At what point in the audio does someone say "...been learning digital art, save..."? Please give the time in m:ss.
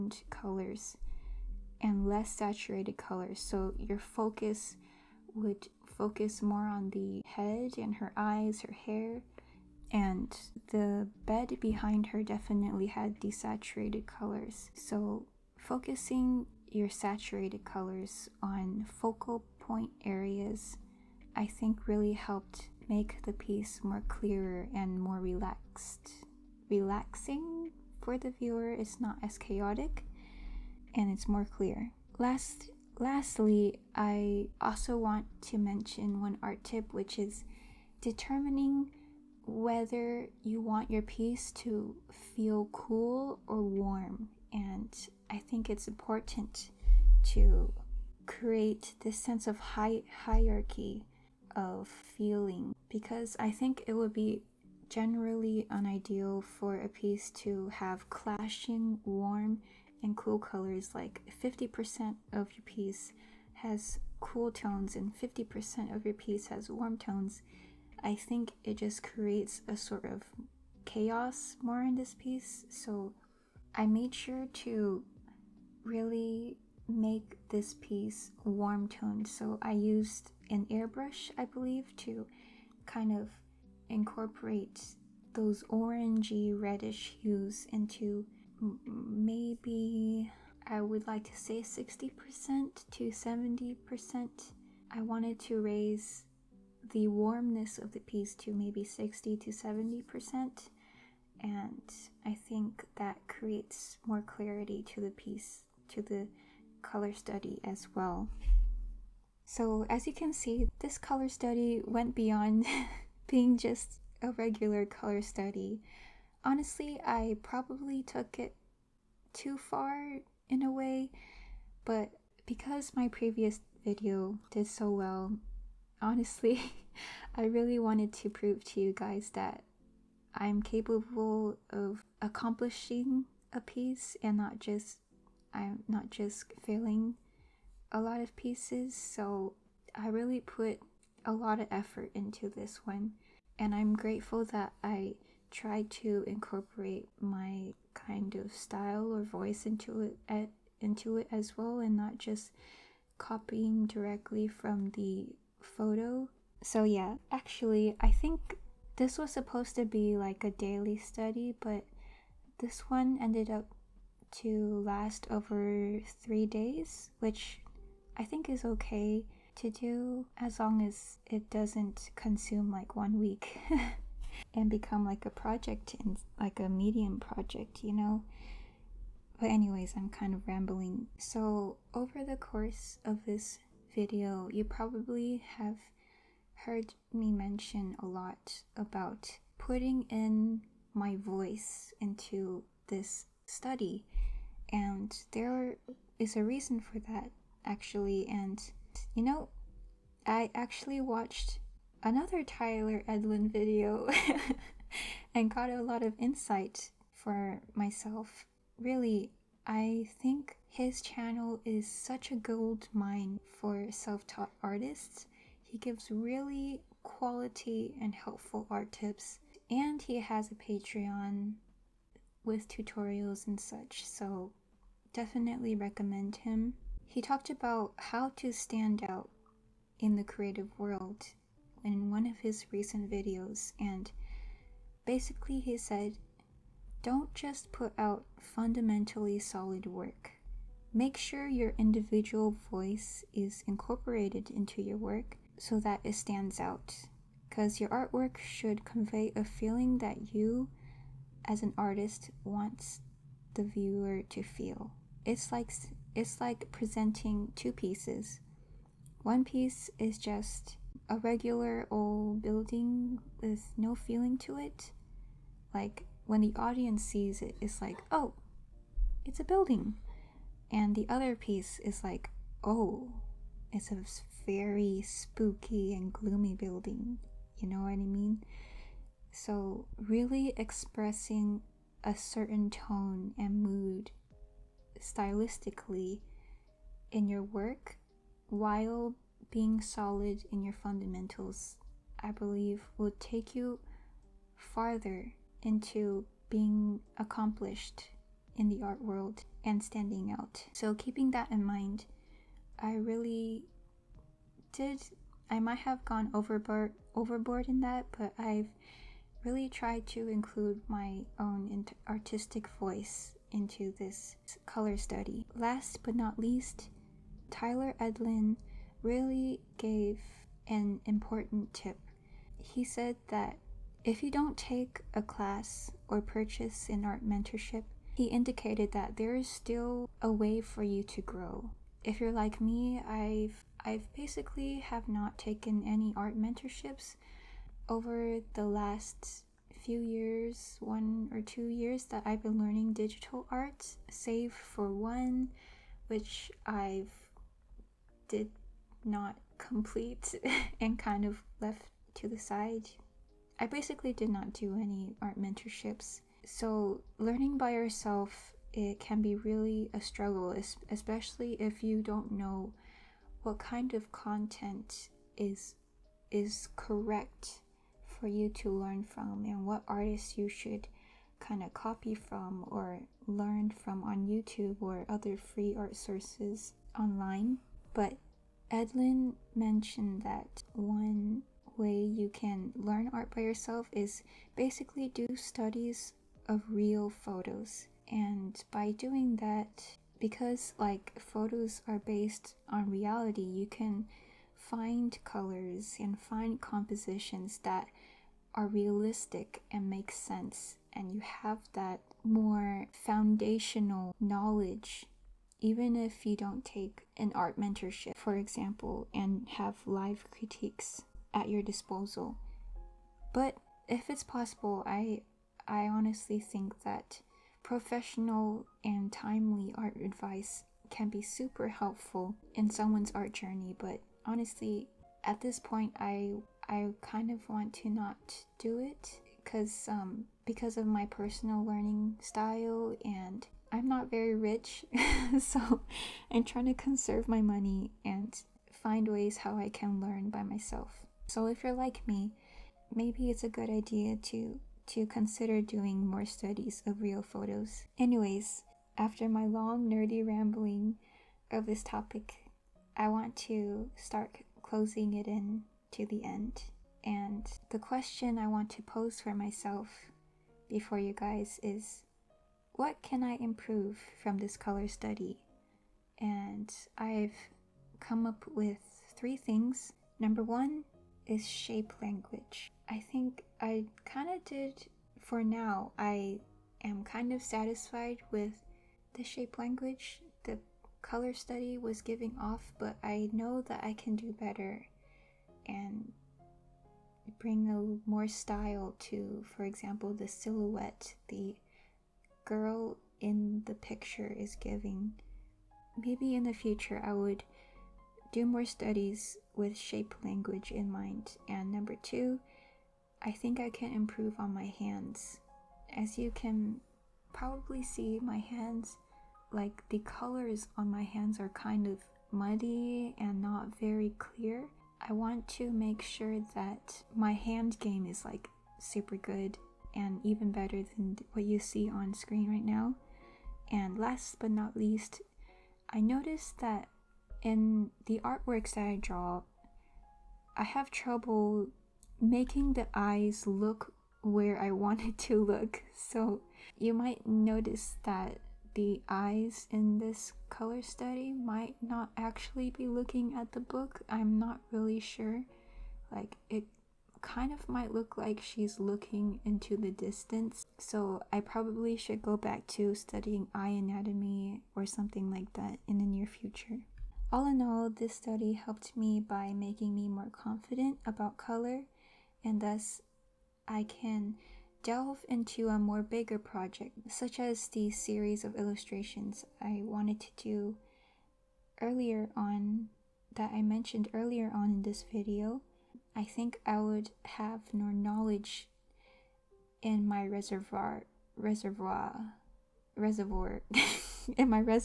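5:42.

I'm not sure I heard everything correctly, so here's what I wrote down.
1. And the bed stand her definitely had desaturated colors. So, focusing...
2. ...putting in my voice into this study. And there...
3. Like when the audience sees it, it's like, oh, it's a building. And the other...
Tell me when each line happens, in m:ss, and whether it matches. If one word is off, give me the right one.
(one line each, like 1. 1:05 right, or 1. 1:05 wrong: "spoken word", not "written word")
1. 0:09 wrong: "behind", not "stand"
2. 3:09 right
3. 4:25 right.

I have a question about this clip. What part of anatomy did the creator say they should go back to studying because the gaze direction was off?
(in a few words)
Eye anatomy.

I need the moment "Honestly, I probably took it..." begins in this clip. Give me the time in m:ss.
1:56.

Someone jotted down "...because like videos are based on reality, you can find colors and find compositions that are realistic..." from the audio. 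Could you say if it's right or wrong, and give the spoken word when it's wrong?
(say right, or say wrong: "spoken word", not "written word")
wrong: "photos", not "videos".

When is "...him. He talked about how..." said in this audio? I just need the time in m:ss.
3:46.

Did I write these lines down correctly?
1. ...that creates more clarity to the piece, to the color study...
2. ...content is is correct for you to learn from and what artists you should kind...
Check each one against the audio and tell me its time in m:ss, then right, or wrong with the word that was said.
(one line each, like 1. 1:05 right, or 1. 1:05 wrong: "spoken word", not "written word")
1. 1:42 right
2. 6:04 right.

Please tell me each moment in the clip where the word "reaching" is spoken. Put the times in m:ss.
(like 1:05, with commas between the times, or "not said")
not said.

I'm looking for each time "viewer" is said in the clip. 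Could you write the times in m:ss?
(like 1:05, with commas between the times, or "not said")
0:28, 4:13.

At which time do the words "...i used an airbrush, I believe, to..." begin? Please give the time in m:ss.
1:19.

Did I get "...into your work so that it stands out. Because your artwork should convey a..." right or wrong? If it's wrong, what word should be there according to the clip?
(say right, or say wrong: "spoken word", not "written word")
right.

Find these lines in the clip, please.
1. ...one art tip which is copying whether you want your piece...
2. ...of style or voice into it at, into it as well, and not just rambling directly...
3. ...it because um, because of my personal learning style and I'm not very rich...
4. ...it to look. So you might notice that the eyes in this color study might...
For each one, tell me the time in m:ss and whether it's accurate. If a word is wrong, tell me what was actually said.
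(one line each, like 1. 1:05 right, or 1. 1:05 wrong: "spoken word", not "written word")
1. 0:36 wrong: "determining", not "copying"
2. 2:28 wrong: "copying", not "rambling"
3. 7:08 right
4. 8:55 right.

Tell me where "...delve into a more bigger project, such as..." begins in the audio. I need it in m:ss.
9:24.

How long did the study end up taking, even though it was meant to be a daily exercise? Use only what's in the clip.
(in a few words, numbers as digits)
Over three days.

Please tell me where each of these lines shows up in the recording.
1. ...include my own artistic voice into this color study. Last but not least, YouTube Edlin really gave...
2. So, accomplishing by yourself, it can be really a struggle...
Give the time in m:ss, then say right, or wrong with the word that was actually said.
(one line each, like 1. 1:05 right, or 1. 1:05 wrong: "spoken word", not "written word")
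1. 5:10 wrong: "Tyler", not "YouTube"
2. 5:56 wrong: "learning", not "accomplishing".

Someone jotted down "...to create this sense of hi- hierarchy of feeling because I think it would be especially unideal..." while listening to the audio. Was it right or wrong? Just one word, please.
wrong.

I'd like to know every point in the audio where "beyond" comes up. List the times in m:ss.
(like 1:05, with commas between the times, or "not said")
1:52.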